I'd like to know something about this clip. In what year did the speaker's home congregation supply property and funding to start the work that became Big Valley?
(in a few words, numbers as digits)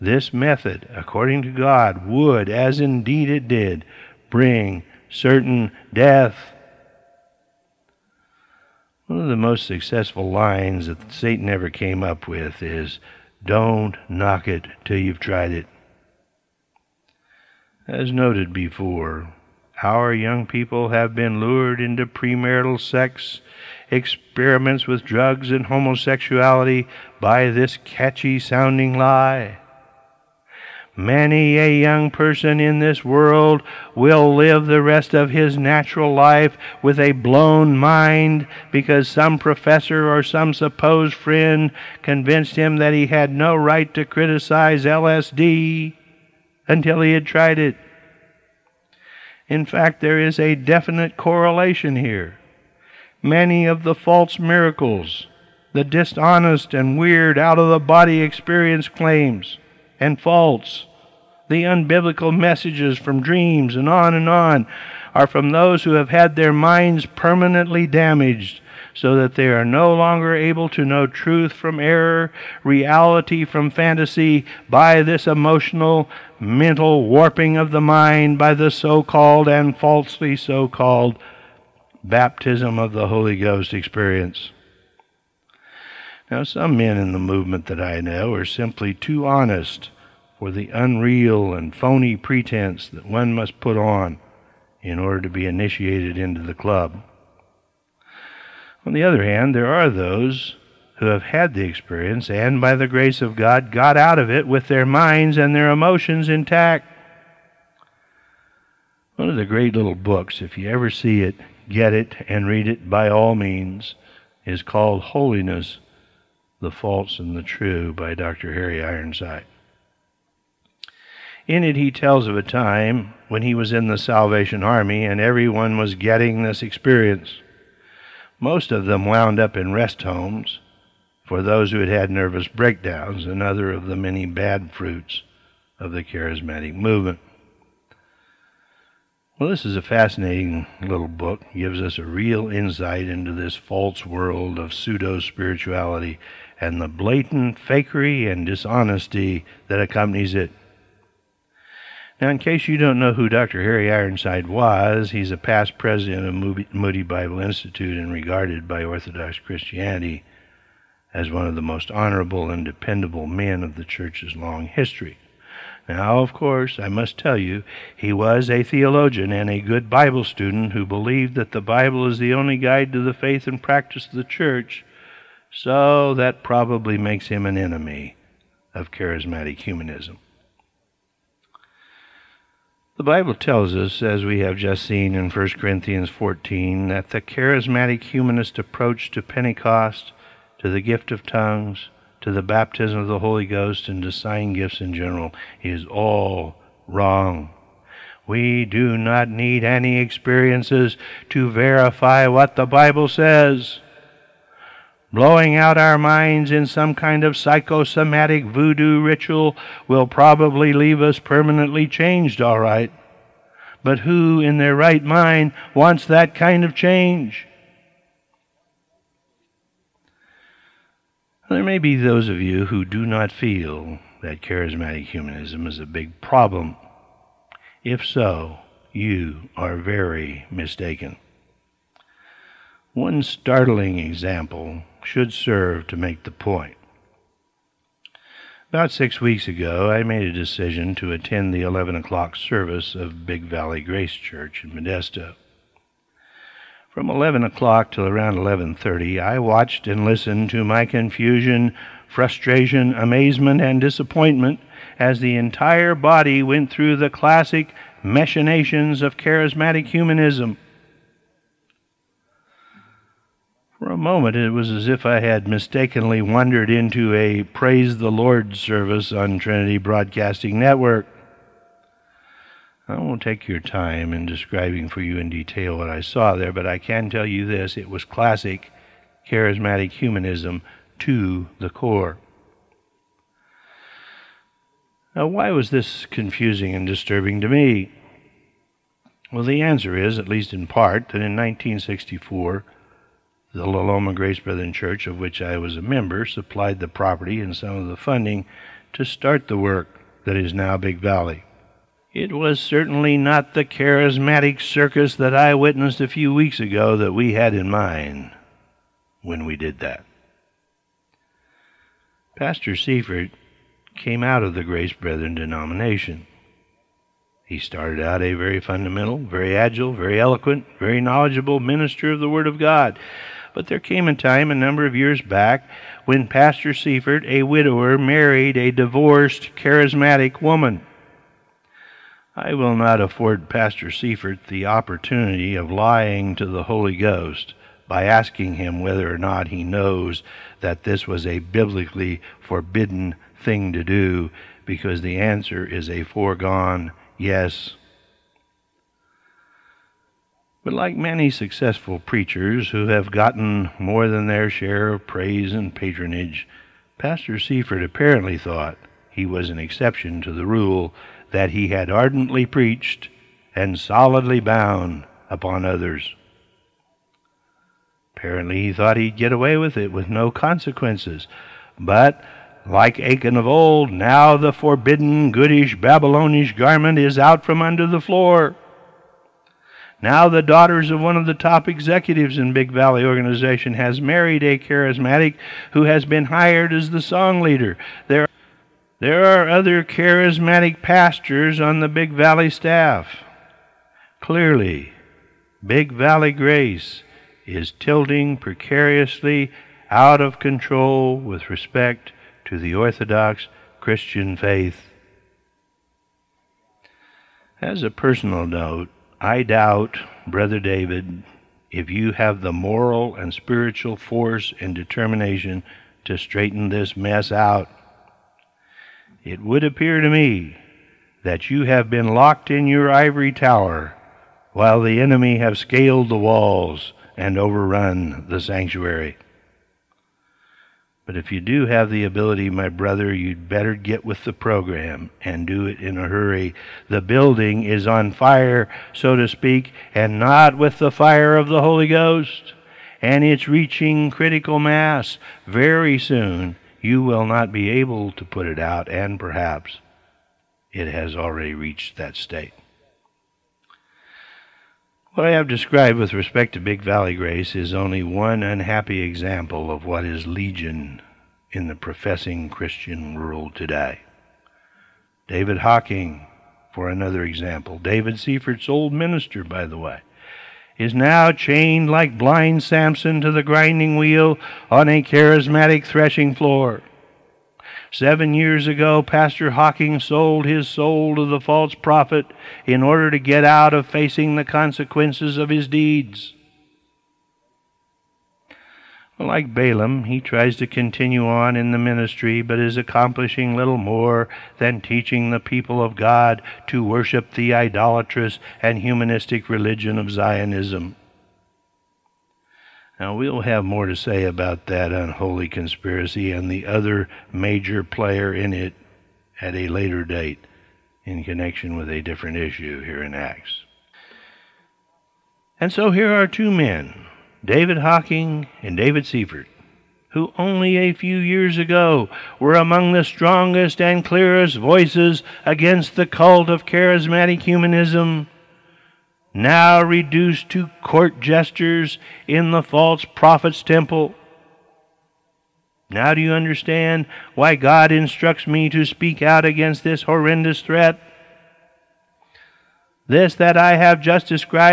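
1964.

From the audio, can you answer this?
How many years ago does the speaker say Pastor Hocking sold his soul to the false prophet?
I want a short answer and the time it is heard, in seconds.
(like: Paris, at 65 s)
7, at 477 s.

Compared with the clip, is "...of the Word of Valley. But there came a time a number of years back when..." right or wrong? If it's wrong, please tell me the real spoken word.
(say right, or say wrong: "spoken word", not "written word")
wrong: "God", not "Valley".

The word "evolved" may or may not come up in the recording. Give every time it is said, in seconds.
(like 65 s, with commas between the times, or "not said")
not said.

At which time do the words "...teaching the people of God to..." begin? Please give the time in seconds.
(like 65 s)
494 s.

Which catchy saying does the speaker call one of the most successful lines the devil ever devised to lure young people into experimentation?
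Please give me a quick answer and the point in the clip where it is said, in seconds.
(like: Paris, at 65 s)
Don't knock it till you've tried it, at 13 s.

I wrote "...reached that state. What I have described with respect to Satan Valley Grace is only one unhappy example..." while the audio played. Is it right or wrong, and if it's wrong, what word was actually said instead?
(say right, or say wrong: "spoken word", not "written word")
wrong: "Big", not "Satan".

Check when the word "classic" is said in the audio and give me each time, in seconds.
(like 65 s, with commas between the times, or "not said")
257 s, 278 s.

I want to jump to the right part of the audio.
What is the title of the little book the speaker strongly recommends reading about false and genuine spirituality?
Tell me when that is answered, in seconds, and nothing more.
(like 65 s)
115 s.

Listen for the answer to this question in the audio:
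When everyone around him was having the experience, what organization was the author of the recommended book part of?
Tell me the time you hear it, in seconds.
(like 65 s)
123 s.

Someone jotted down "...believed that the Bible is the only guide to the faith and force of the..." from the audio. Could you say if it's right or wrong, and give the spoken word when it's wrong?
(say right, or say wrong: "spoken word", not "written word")
wrong: "practice", not "force".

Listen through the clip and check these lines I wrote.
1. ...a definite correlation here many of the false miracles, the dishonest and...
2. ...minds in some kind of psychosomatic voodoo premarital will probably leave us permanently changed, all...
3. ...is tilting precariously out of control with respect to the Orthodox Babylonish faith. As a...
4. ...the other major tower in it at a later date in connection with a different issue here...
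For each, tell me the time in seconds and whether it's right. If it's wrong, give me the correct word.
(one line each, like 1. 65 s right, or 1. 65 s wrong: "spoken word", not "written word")
1. 50 s right
2. 205 s wrong: "ritual", not "premarital"
3. 397 s wrong: "Christian", not "Babylonish"
4. 506 s wrong: "player", not "tower".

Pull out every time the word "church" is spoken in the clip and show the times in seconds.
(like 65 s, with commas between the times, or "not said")
163 s, 174 s, 244 s, 294 s.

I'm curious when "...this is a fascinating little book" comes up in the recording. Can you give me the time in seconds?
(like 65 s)
139 s.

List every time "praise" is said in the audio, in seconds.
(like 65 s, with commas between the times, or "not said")
267 s, 355 s.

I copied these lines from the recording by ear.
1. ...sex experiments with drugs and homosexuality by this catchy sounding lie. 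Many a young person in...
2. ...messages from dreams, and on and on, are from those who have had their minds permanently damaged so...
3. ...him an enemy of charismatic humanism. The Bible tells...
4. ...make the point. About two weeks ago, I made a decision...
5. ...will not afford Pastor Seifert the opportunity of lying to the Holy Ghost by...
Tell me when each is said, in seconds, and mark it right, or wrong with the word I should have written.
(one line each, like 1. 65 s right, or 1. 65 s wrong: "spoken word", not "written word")
1. 22 s right
2. 62 s right
3. 177 s right
4. 235 s wrong: "six", not "two"
5. 332 s right.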